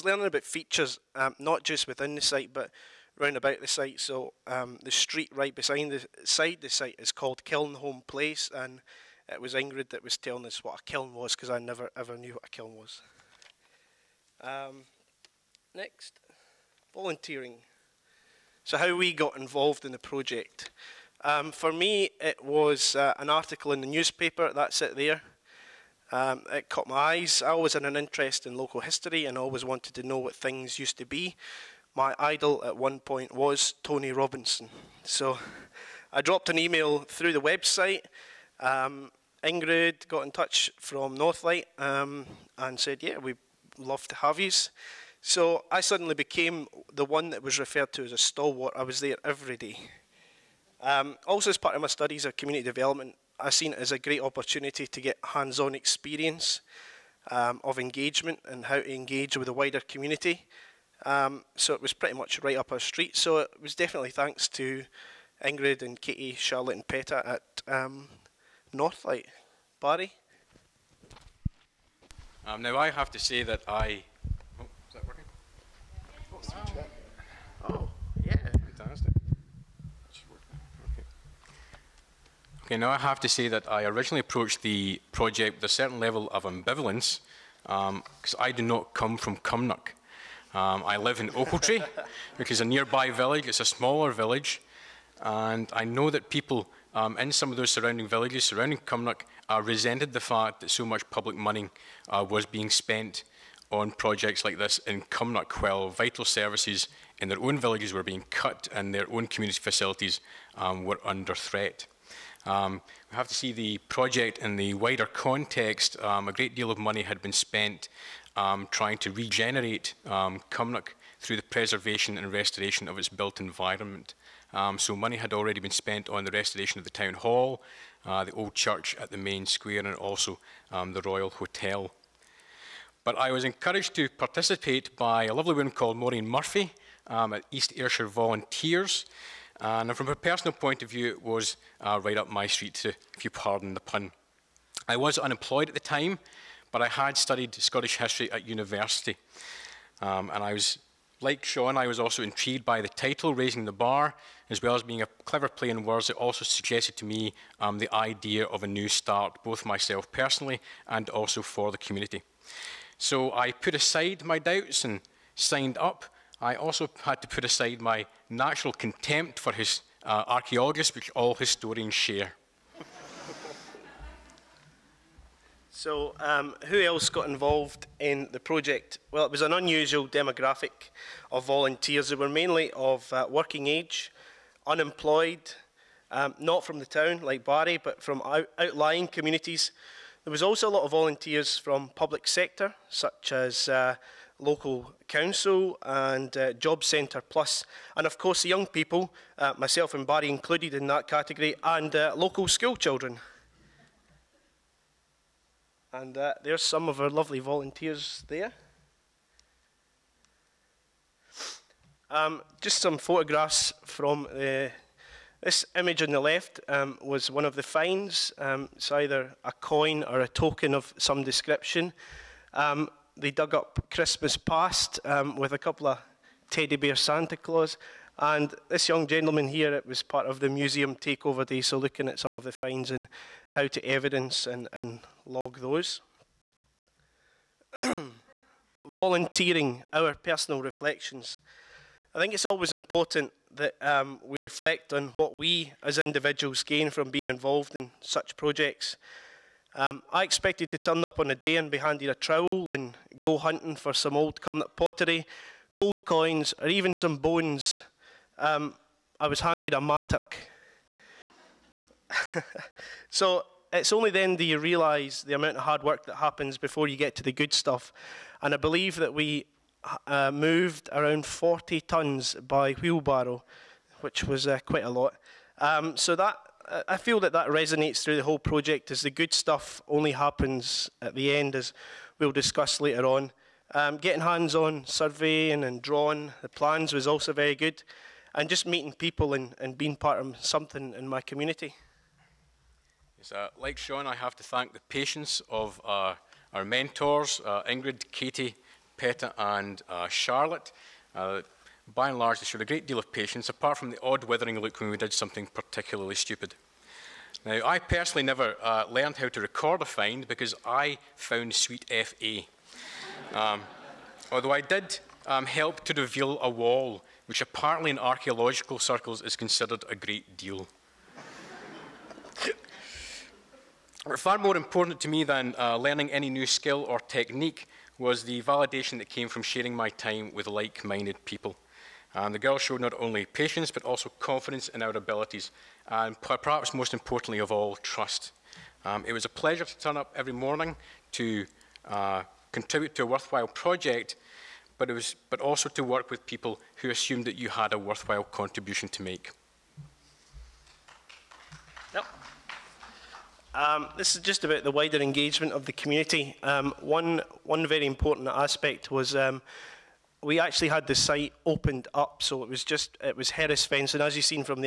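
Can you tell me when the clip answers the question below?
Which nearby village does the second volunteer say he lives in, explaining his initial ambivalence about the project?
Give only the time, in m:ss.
1:31.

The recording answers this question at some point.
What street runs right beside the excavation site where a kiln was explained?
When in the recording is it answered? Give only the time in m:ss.
0:07.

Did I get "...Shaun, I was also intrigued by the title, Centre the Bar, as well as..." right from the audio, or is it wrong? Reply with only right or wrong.
wrong.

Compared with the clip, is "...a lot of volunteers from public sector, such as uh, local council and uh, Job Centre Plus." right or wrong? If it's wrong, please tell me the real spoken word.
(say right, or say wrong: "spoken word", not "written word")
right.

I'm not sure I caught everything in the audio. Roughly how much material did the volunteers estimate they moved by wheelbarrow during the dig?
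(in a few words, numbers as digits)
40 tonnes.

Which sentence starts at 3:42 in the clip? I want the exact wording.
Um, they dug up Christmas past um, with a couple of teddy bear Santa Claus.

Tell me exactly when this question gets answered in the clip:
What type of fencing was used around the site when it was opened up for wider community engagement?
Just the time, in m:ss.
6:03.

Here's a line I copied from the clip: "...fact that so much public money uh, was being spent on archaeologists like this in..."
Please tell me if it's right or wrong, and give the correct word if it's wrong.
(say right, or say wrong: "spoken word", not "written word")
wrong: "projects", not "archaeologists".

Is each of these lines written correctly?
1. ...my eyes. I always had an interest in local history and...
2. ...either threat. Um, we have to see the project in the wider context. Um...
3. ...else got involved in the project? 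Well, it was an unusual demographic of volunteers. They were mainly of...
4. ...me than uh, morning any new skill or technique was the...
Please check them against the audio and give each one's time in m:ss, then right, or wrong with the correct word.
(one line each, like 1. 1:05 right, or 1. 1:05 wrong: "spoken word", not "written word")
1. 0:26 right
2. 1:51 wrong: "under", not "either"
3. 2:56 right
4. 5:25 wrong: "learning", not "morning".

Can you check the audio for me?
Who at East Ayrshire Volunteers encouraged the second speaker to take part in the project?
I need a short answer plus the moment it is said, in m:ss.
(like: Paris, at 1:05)
Maureen Murphy, at 2:15.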